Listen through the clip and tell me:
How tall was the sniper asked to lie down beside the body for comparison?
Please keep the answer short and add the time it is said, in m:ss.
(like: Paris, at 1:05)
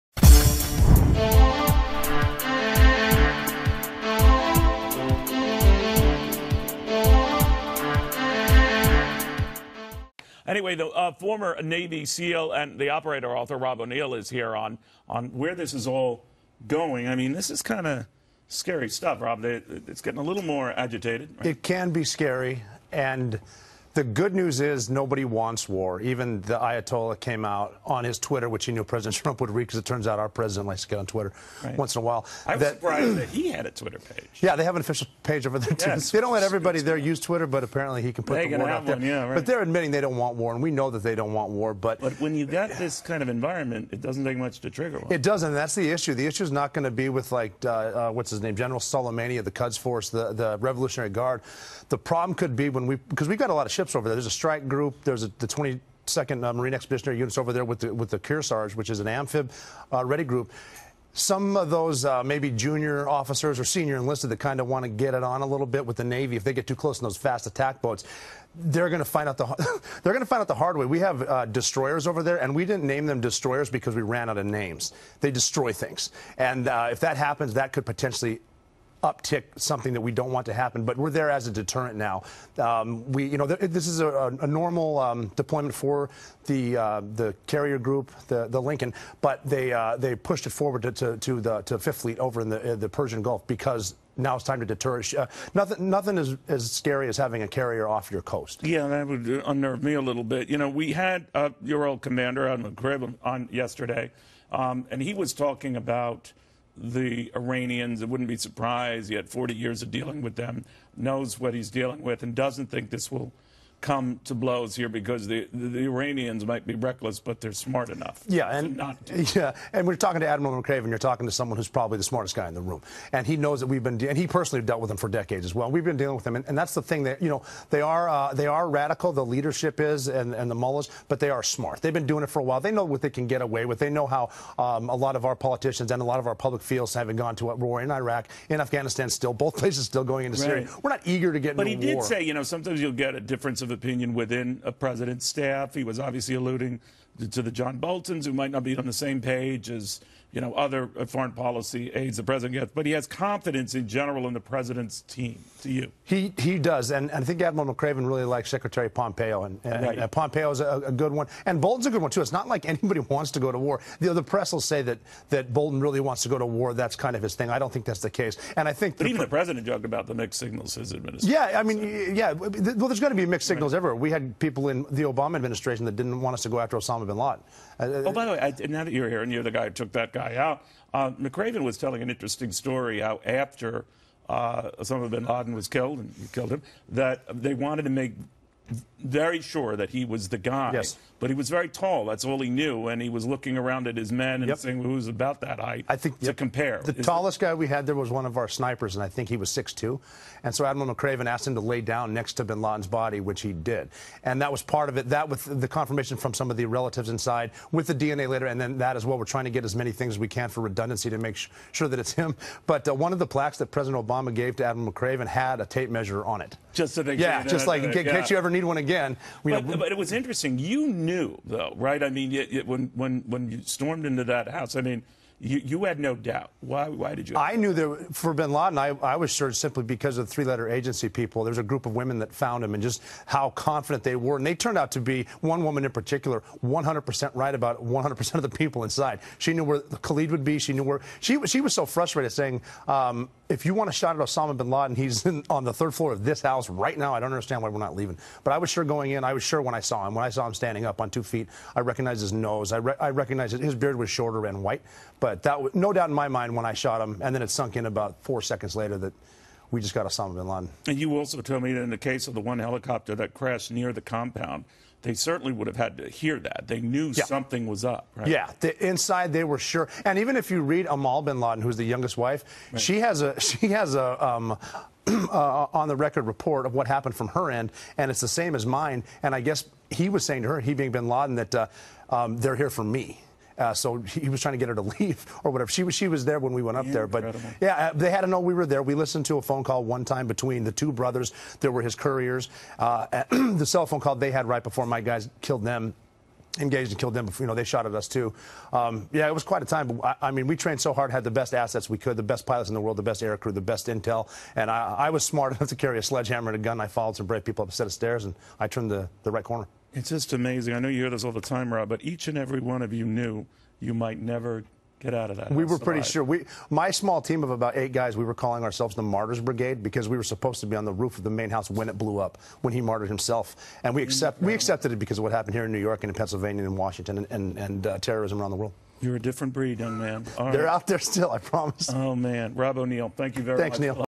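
6'2, at 3:19.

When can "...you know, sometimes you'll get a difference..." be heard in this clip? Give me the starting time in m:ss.
2:22.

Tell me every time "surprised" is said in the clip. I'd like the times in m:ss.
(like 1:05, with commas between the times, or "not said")
0:32, 1:48.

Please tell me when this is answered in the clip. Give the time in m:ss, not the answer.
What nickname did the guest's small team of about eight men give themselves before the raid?
5:19.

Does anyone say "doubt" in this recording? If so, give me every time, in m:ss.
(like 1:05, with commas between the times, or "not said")
3:46, 4:15.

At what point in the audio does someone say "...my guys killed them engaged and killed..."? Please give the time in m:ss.
4:54.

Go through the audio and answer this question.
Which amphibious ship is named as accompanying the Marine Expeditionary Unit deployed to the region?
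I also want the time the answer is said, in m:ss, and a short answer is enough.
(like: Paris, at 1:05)
Kearsarge, at 0:58.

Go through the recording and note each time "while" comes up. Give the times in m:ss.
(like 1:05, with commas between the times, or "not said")
0:32, 2:12.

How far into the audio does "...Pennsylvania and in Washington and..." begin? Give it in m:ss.
5:26.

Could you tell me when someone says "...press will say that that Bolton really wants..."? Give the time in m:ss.
2:44.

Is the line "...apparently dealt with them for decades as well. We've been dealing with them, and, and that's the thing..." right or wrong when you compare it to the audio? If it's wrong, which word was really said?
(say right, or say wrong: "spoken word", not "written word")
wrong: "personally", not "apparently".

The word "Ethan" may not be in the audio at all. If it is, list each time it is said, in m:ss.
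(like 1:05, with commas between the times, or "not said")
not said.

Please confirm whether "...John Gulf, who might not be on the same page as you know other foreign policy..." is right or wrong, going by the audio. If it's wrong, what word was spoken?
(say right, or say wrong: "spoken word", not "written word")
wrong: "Boltons", not "Gulf".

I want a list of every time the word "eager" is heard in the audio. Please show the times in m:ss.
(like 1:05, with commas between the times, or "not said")
2:21.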